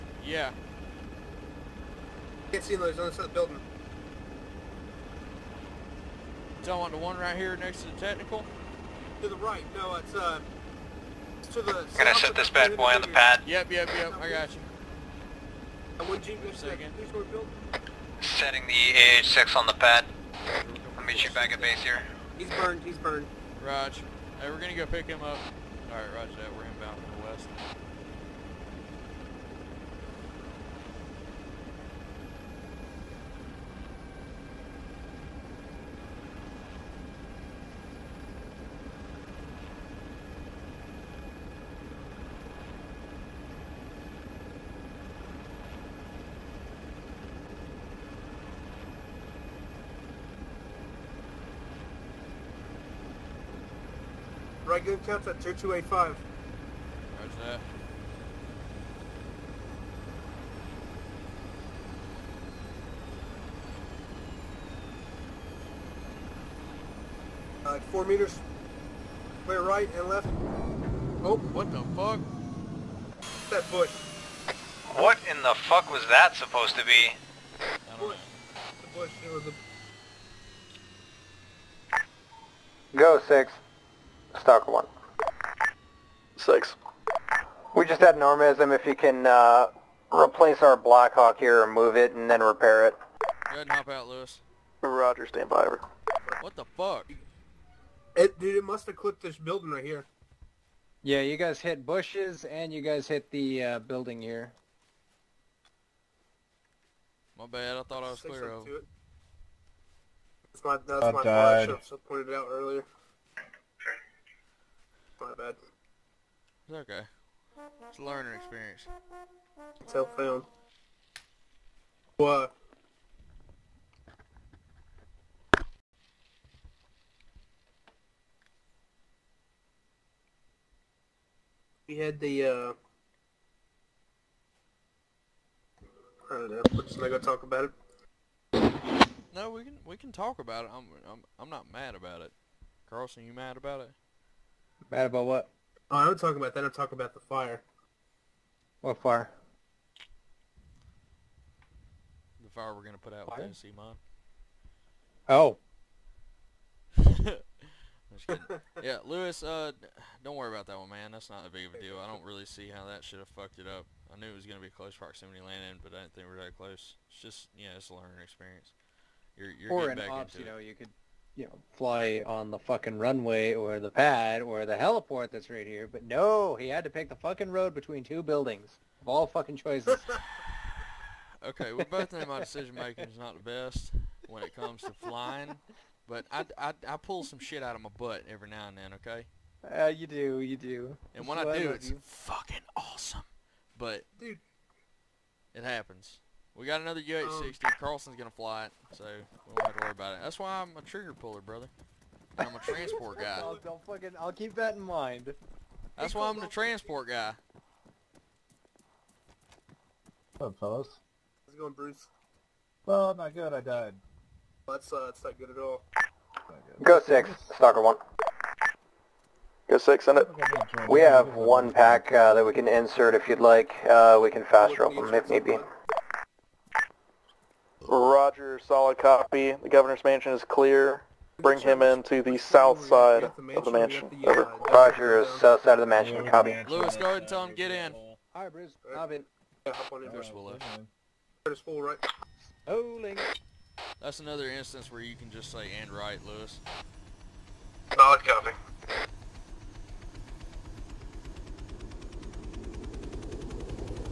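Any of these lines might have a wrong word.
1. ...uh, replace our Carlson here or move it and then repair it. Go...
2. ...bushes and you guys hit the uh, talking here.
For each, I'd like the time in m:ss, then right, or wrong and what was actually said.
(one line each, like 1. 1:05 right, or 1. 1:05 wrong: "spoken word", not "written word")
1. 1:29 wrong: "Blackhawk", not "Carlson"
2. 1:41 wrong: "building", not "talking".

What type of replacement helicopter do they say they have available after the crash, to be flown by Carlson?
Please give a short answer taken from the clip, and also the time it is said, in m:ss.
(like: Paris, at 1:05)
UH-60, at 3:17.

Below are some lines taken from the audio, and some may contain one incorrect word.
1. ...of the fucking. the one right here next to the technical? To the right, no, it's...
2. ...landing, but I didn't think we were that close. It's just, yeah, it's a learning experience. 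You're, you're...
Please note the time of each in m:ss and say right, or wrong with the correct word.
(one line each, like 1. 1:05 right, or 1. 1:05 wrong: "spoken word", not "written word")
1. 0:03 wrong: "building", not "fucking"
2. 2:45 right.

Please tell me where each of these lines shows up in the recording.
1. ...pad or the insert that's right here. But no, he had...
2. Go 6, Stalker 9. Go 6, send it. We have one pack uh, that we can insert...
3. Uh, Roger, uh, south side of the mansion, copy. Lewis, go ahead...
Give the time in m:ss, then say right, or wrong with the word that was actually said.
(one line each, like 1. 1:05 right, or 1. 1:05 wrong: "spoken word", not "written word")
1. 2:53 wrong: "heliport", not "insert"
2. 3:36 wrong: "1", not "9"
3. 3:54 right.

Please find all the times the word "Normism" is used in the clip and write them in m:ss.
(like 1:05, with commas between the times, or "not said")
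1:28.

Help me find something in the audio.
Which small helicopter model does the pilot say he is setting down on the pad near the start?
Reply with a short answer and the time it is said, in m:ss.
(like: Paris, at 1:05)
AH-6, at 0:18.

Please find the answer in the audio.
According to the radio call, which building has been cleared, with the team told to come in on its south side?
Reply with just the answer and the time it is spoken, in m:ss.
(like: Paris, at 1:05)
governor's mansion, at 3:49.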